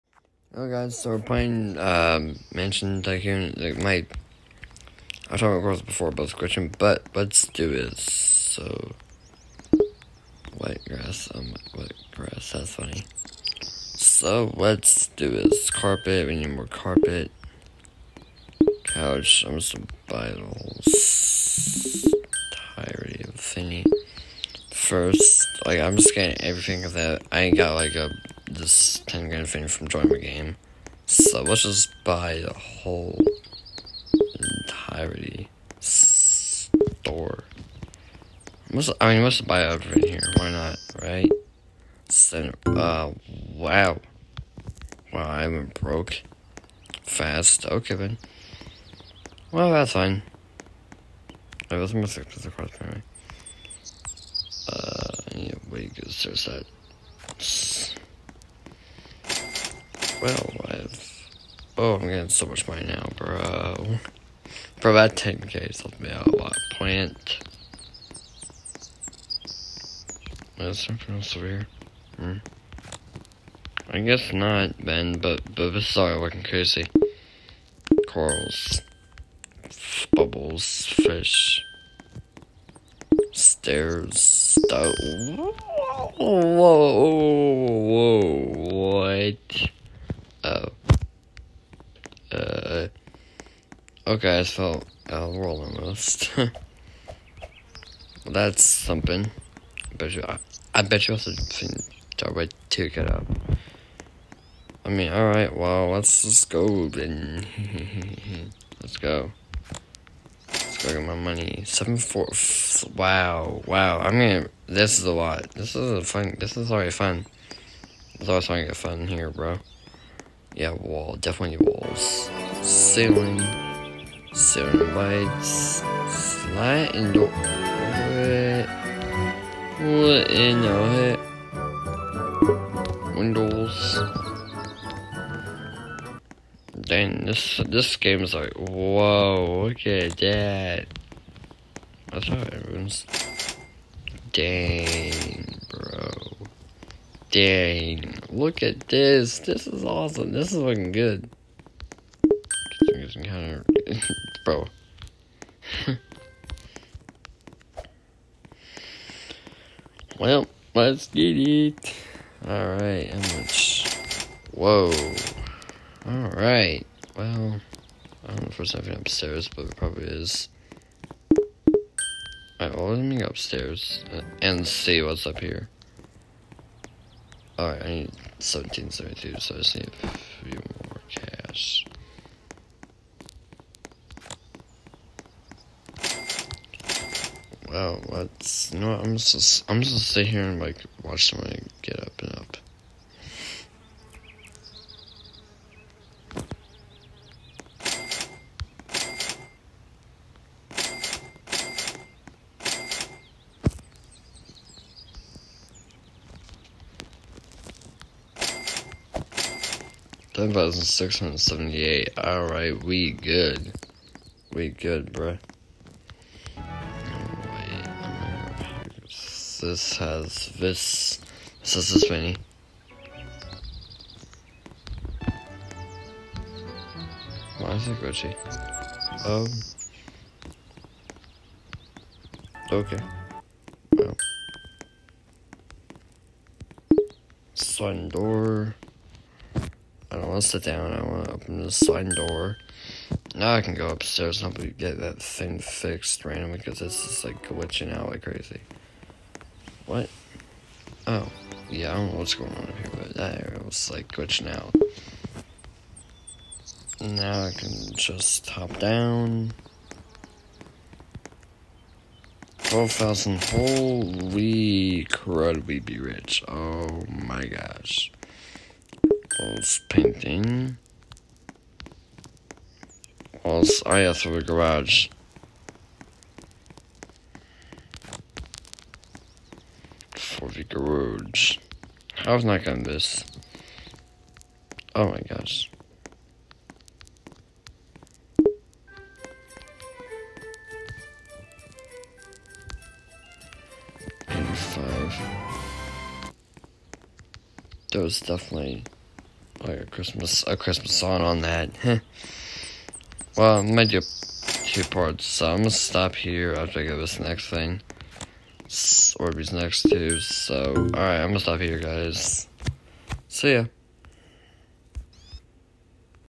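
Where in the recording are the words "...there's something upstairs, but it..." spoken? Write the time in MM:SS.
02:48.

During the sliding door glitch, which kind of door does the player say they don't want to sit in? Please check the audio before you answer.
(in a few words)
Sun door.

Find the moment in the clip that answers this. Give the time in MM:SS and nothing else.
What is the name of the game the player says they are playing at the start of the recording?
00:02.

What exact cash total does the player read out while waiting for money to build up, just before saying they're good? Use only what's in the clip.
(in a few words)
10,678.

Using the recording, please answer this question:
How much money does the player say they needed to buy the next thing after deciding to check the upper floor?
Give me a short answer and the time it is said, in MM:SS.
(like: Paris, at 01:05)
1772, at 02:58.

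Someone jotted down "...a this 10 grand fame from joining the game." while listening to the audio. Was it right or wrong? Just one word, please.
right.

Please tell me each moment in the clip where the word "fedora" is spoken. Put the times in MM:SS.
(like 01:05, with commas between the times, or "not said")
not said.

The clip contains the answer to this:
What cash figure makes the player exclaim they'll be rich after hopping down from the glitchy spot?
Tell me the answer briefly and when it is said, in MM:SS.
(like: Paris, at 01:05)
12,000, at 04:22.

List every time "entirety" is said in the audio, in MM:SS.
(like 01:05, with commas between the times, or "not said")
00:22, 00:34.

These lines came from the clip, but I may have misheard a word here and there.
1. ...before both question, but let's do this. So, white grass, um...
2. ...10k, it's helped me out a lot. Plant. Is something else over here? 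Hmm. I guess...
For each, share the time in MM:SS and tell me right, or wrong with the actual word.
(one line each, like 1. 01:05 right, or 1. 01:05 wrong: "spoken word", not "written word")
1. 00:05 right
2. 01:05 right.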